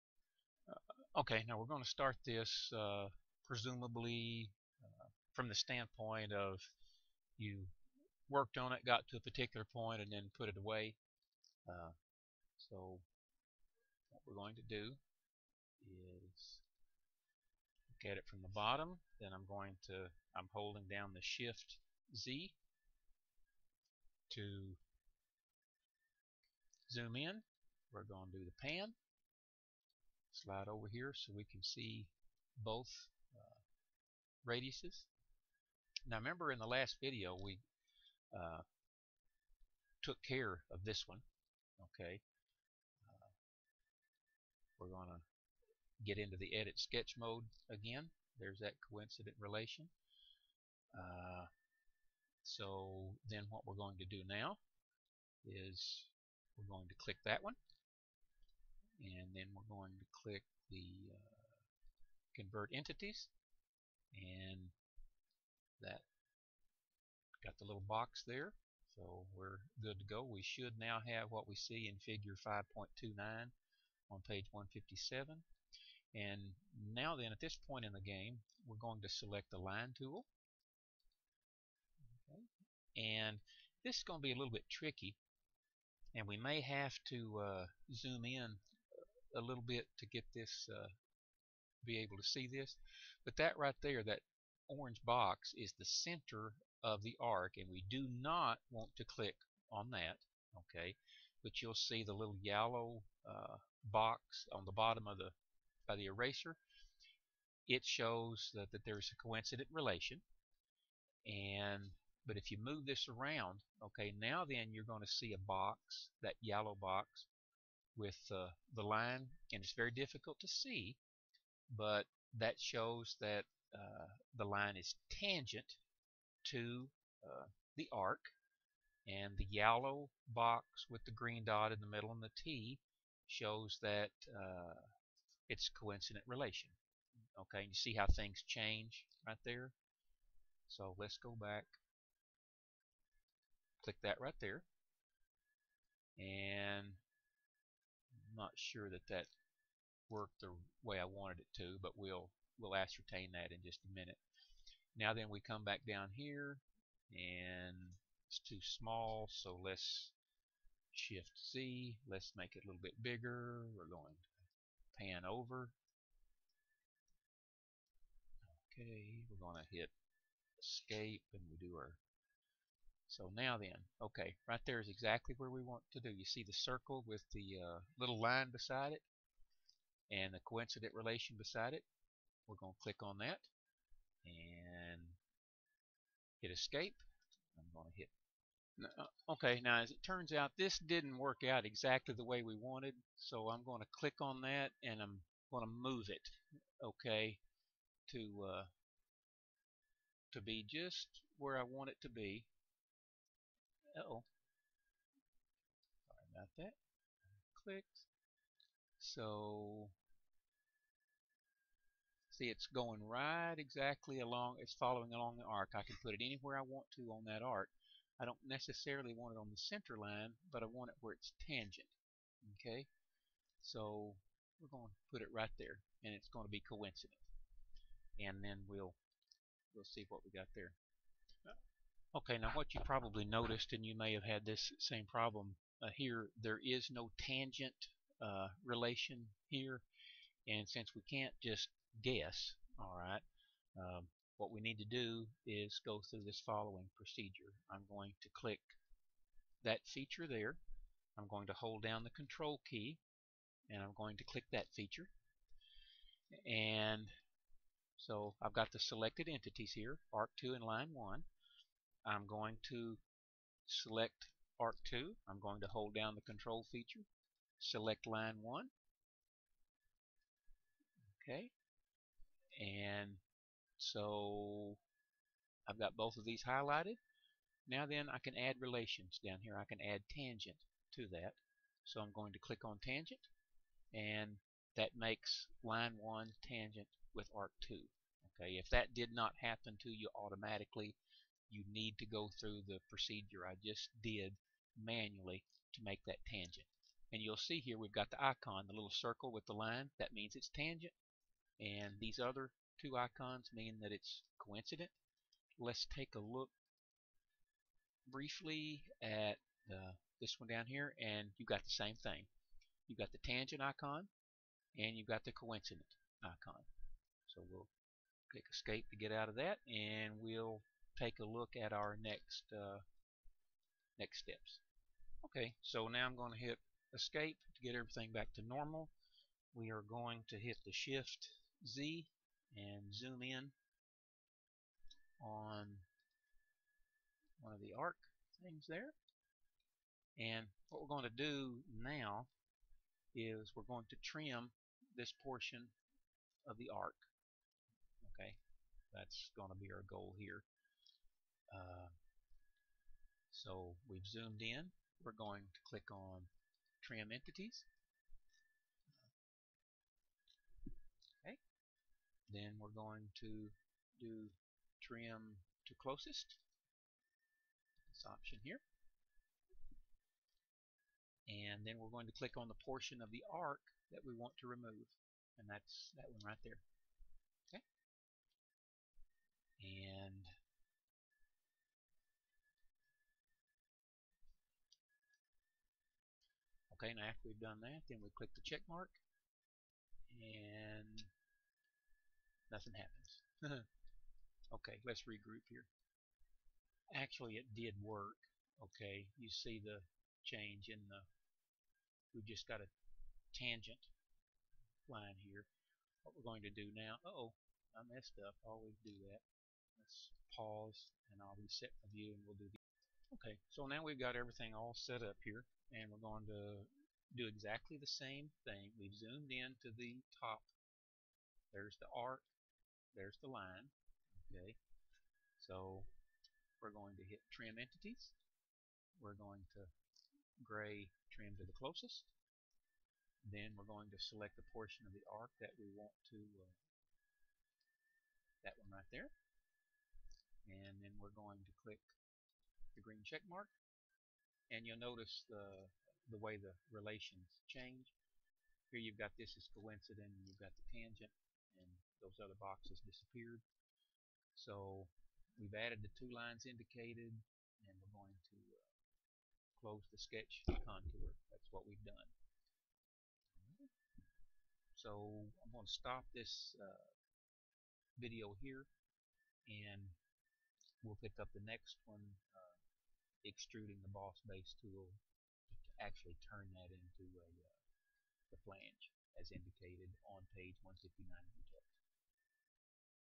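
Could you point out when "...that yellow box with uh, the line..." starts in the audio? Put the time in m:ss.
1:56.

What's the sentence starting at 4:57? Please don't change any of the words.
And you'll see here we've got the icon, the little circle with the line.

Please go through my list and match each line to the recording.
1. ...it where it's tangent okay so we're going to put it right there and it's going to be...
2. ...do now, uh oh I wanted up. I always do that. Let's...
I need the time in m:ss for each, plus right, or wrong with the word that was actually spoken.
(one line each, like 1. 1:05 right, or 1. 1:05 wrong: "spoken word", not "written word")
1. 3:40 right
2. 6:46 wrong: "messed", not "wanted".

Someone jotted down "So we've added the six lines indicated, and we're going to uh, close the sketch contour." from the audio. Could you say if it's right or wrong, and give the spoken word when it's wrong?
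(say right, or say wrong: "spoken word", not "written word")
wrong: "two", not "six".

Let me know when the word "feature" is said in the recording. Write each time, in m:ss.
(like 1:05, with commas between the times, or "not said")
4:09, 4:14, 4:26.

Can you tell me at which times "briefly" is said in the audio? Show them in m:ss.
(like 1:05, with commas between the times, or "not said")
5:08.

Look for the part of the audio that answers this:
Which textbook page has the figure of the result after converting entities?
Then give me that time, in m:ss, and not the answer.
1:14.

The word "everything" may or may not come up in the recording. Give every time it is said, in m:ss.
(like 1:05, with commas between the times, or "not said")
5:27, 6:54.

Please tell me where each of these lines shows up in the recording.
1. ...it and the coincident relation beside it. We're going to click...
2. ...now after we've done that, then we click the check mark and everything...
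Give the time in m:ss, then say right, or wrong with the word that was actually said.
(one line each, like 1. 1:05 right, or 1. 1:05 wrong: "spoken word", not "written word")
1. 2:58 right
2. 6:26 wrong: "nothing", not "everything".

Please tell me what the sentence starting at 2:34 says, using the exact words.
Now then, we come back down here, and it's too small, so let's Shift Z.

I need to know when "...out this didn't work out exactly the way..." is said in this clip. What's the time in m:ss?
3:10.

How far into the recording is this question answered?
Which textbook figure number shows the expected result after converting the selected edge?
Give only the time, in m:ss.
1:11.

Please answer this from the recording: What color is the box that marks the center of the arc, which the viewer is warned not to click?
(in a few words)
Orange.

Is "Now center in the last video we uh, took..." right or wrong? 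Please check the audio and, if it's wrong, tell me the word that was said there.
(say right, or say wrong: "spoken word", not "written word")
wrong: "remember", not "center".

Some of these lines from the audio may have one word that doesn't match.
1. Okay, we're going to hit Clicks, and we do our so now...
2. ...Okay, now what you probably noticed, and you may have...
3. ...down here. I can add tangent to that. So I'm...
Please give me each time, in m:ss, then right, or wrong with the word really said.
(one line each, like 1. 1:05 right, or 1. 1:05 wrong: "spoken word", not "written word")
1. 2:48 wrong: "Escape", not "Clicks"
2. 3:52 right
3. 4:39 right.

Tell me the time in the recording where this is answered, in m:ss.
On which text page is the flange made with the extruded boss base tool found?
8:00.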